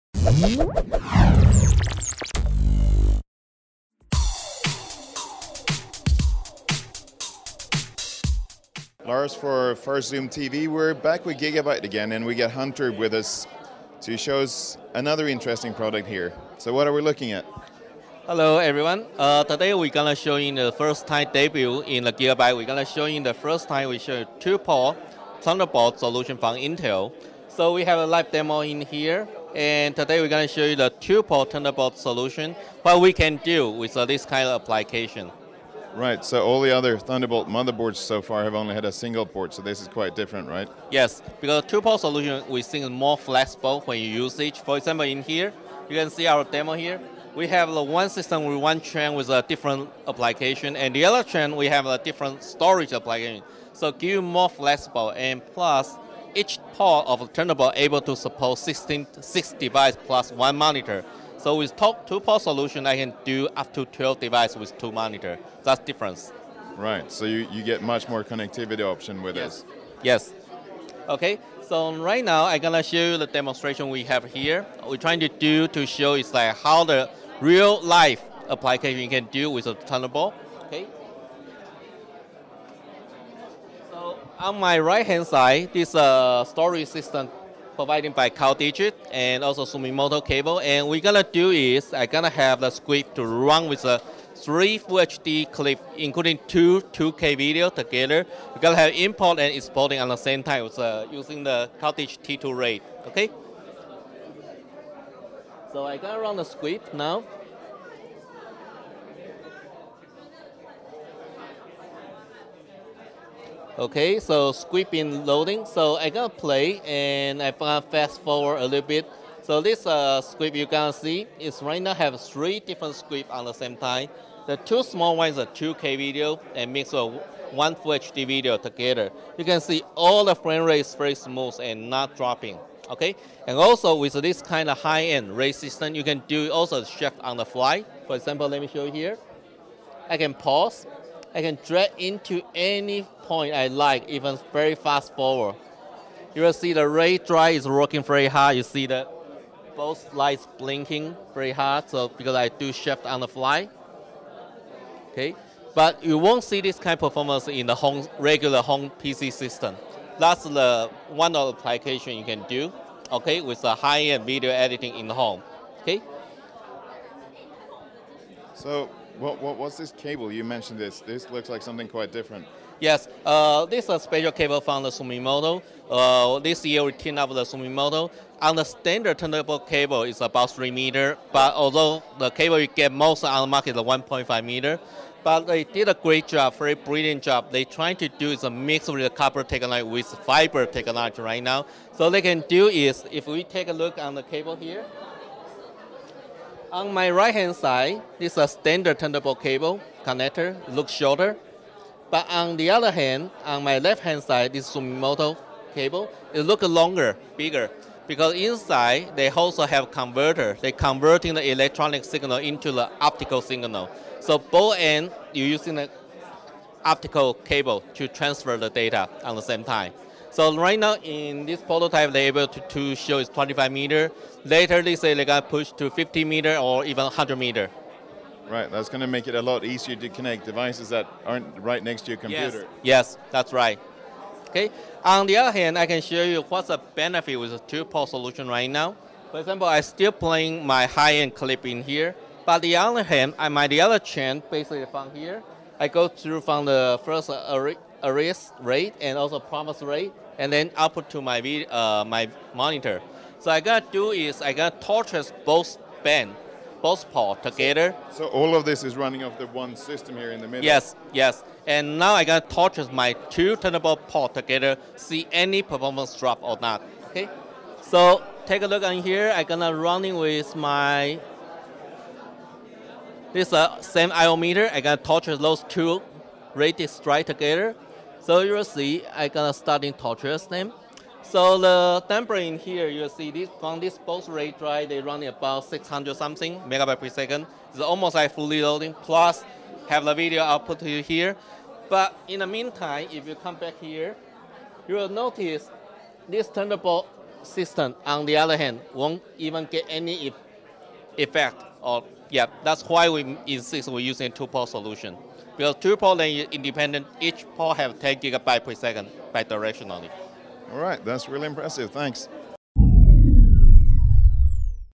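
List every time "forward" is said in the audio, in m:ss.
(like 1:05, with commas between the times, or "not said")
1:58, 2:25.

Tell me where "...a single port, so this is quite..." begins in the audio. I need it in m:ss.
0:38.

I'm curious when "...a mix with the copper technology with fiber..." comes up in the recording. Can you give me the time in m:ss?
3:08.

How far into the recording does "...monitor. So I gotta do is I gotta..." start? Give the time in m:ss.
4:12.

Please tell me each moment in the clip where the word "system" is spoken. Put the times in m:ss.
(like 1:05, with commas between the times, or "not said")
0:48, 1:26, 2:15, 2:39, 4:19, 4:57.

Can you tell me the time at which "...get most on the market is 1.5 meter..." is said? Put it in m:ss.
3:02.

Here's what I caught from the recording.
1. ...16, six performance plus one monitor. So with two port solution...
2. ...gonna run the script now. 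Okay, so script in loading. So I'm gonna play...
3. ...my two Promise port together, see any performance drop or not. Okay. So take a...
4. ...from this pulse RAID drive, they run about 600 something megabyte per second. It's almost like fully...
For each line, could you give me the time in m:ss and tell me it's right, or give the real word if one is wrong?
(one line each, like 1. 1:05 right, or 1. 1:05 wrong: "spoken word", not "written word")
1. 0:58 wrong: "device", not "performance"
2. 1:45 right
3. 4:22 wrong: "Thunderbolt", not "Promise"
4. 4:43 right.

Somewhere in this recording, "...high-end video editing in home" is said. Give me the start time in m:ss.
2:43.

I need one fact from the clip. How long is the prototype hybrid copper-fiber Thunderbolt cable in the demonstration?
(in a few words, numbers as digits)
25 meters.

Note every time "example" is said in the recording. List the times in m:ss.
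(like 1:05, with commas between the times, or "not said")
0:44, 2:18, 3:59.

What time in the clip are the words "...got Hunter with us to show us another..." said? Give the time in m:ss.
0:12.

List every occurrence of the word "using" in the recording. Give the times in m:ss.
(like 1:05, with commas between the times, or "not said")
1:41, 3:35, 5:03.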